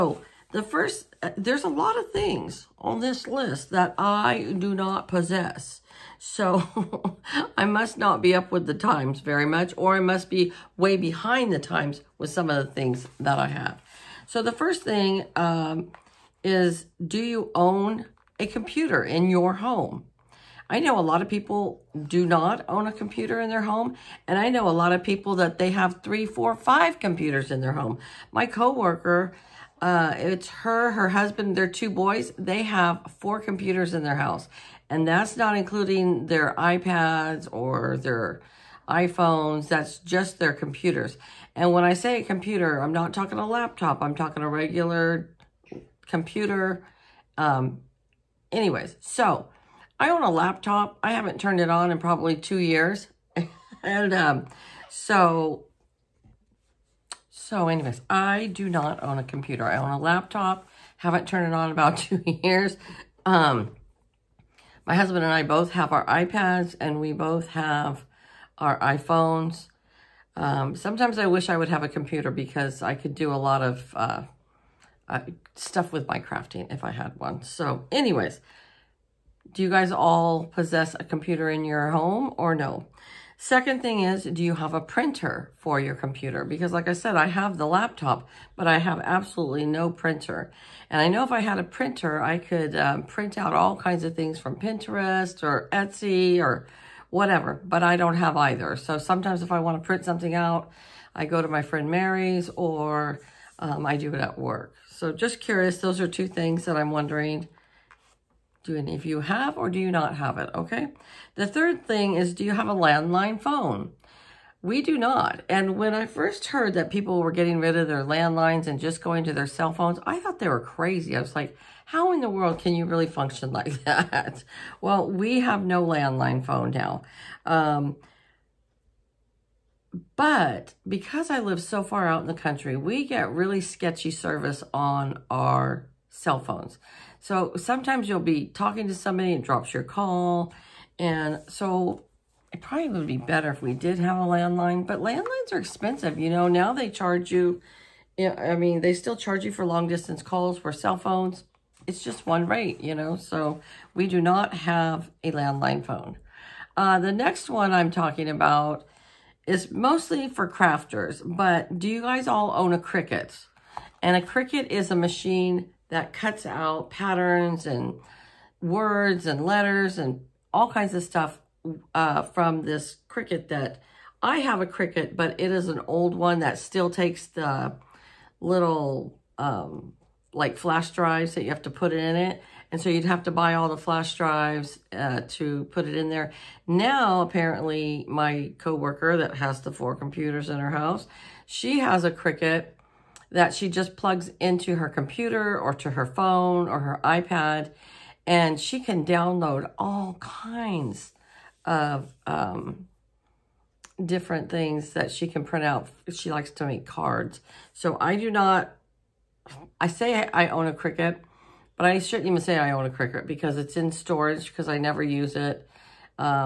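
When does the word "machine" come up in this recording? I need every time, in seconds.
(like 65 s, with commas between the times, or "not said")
164 s.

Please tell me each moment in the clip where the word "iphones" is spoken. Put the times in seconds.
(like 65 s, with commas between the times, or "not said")
38 s, 68 s.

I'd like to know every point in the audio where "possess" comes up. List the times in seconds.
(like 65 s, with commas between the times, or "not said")
5 s, 80 s.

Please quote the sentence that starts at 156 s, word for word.
Uh, the next one I'm talking about is mostly for crafters, but do you guys all own a Cricut?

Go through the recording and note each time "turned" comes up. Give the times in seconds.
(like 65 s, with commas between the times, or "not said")
51 s, 61 s.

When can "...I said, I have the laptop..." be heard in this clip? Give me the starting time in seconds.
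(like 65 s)
86 s.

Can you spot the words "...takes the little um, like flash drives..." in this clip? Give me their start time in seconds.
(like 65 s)
176 s.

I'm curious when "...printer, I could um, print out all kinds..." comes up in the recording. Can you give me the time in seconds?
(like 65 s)
91 s.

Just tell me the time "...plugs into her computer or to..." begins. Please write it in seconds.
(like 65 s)
193 s.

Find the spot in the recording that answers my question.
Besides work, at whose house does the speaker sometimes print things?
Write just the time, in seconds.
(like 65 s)
101 s.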